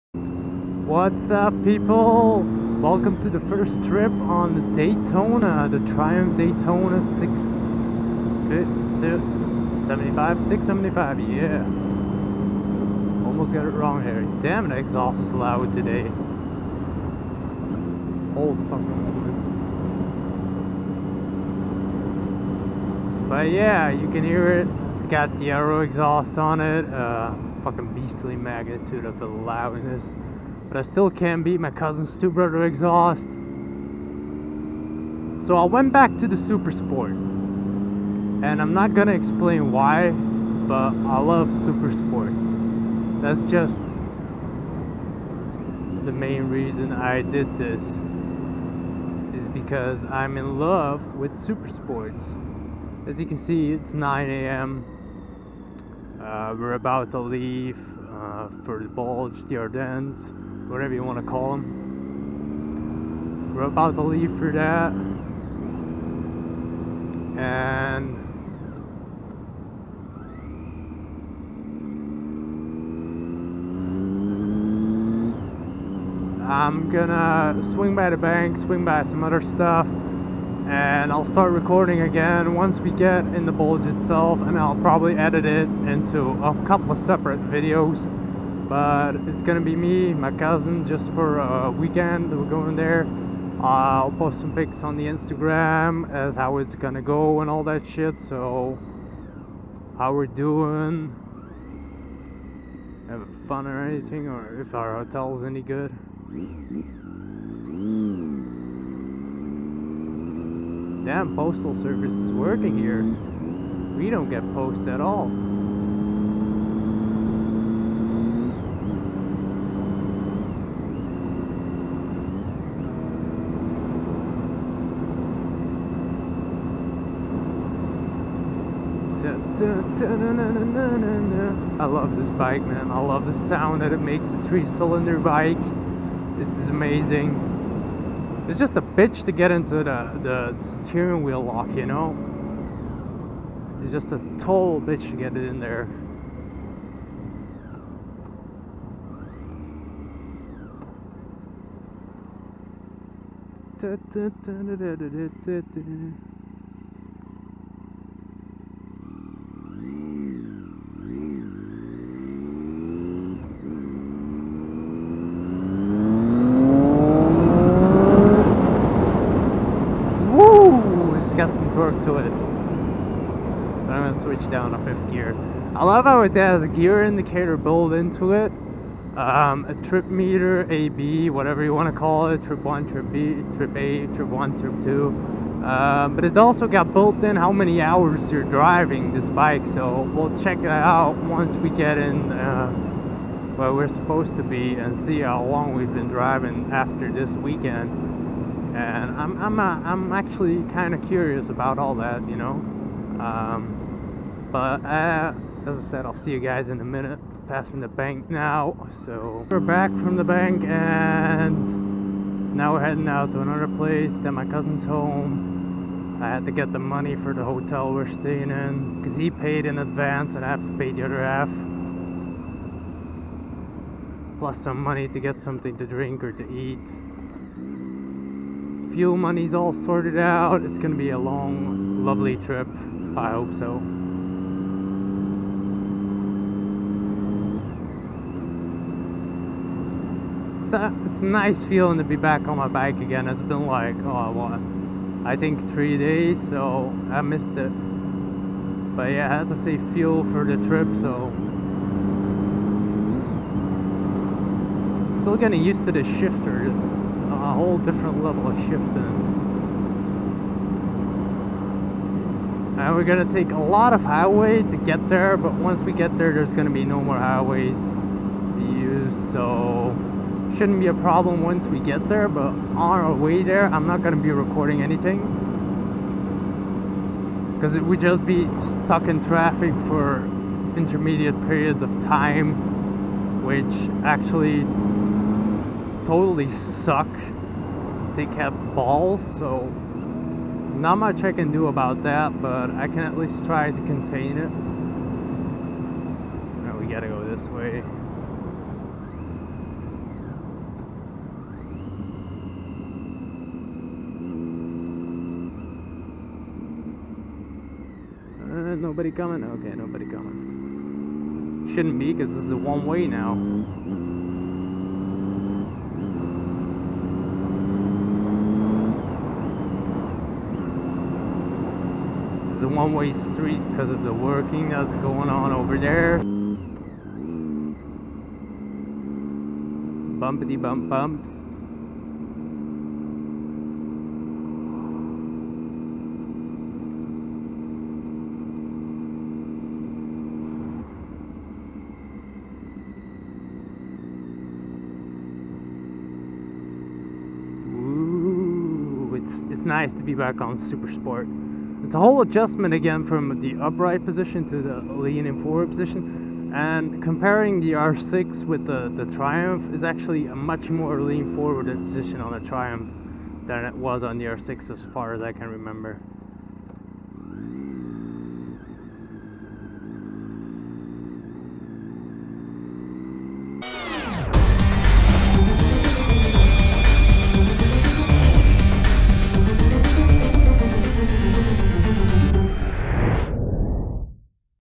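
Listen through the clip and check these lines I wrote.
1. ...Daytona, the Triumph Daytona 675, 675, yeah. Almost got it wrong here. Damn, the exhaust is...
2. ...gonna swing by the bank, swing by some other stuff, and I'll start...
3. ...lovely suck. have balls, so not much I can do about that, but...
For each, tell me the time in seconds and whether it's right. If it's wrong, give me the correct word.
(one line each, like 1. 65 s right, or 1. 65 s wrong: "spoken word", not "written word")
1. 4 s right
2. 76 s right
3. 286 s wrong: "totally", not "lovely".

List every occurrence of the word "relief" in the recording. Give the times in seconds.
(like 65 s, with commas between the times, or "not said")
not said.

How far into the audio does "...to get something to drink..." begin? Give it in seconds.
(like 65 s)
225 s.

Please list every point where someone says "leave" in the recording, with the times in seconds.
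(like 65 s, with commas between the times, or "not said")
57 s, 64 s.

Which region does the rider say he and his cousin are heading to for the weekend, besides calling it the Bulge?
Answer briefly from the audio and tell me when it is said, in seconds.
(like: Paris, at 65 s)
the Ardennes, at 59 s.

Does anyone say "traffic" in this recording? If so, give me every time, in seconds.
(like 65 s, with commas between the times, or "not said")
279 s.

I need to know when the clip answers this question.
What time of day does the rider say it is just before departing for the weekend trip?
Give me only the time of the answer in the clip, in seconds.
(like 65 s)
53 s.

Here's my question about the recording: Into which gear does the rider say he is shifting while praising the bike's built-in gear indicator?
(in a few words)
fifth gear.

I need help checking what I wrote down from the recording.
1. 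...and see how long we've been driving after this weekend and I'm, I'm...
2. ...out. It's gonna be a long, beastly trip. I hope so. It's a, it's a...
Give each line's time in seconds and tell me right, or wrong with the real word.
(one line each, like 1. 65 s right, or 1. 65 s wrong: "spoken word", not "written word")
1. 194 s right
2. 230 s wrong: "lovely", not "beastly".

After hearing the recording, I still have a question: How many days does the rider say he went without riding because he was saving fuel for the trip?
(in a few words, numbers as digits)
3.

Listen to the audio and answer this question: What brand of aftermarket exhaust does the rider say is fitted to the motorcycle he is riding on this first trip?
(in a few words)
Arrow.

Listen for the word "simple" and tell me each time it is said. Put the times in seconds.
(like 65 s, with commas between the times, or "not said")
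not said.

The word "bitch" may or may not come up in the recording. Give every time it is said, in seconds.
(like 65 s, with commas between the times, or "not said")
138 s, 144 s.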